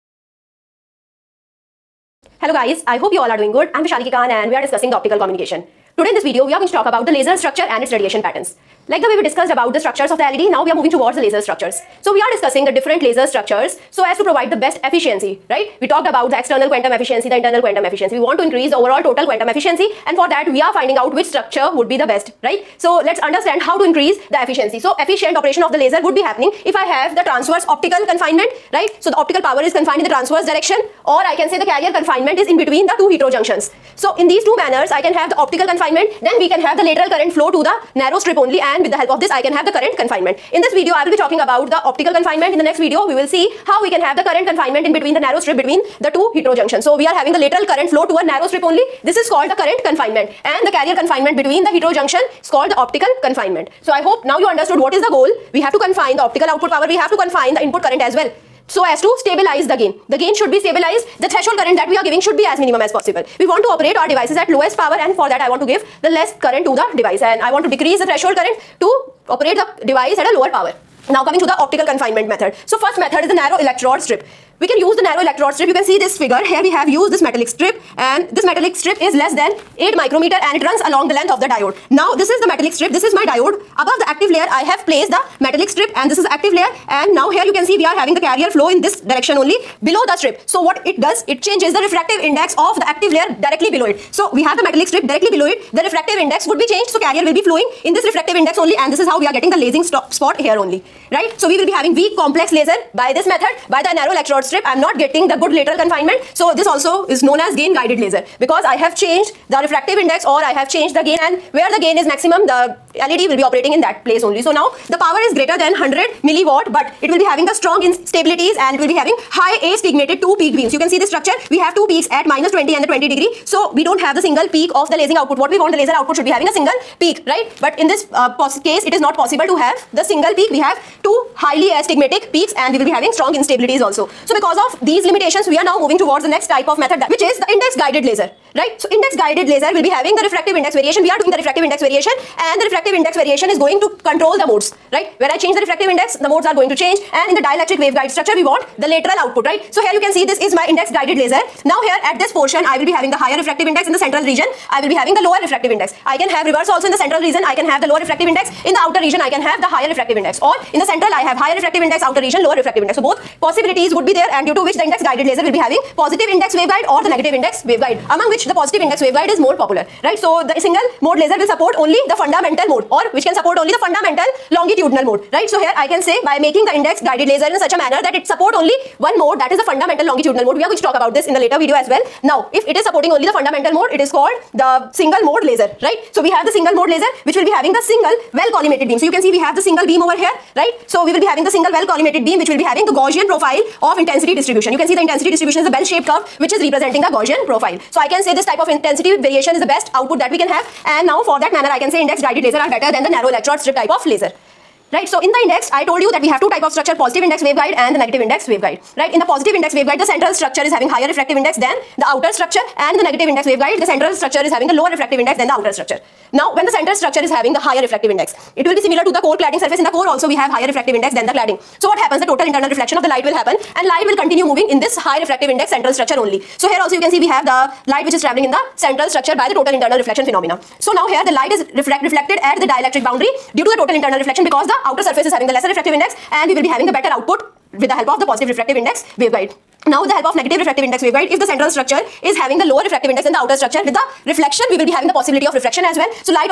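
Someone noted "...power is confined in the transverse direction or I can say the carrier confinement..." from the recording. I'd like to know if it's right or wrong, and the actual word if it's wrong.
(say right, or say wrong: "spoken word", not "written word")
right.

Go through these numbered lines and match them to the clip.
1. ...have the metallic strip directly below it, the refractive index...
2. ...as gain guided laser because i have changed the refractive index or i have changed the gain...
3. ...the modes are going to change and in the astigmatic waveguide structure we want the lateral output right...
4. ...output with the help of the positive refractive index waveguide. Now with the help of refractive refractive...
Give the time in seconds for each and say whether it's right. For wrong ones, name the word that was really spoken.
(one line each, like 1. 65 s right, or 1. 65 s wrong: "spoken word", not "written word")
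1. 94 s right
2. 107 s right
3. 146 s wrong: "dielectric", not "astigmatic"
4. 237 s wrong: "negative", not "refractive".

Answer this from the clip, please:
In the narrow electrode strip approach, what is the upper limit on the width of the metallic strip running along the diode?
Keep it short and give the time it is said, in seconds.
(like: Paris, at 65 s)
8 micrometer, at 79 s.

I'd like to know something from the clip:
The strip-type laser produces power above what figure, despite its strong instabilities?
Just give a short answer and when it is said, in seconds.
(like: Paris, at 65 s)
100 milliwatt, at 115 s.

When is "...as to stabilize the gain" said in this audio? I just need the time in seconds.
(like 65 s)
58 s.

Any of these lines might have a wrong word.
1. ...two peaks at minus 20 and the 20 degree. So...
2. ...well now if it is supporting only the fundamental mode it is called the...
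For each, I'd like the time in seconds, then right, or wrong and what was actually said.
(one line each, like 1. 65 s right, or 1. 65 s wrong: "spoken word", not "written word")
1. 121 s right
2. 181 s right.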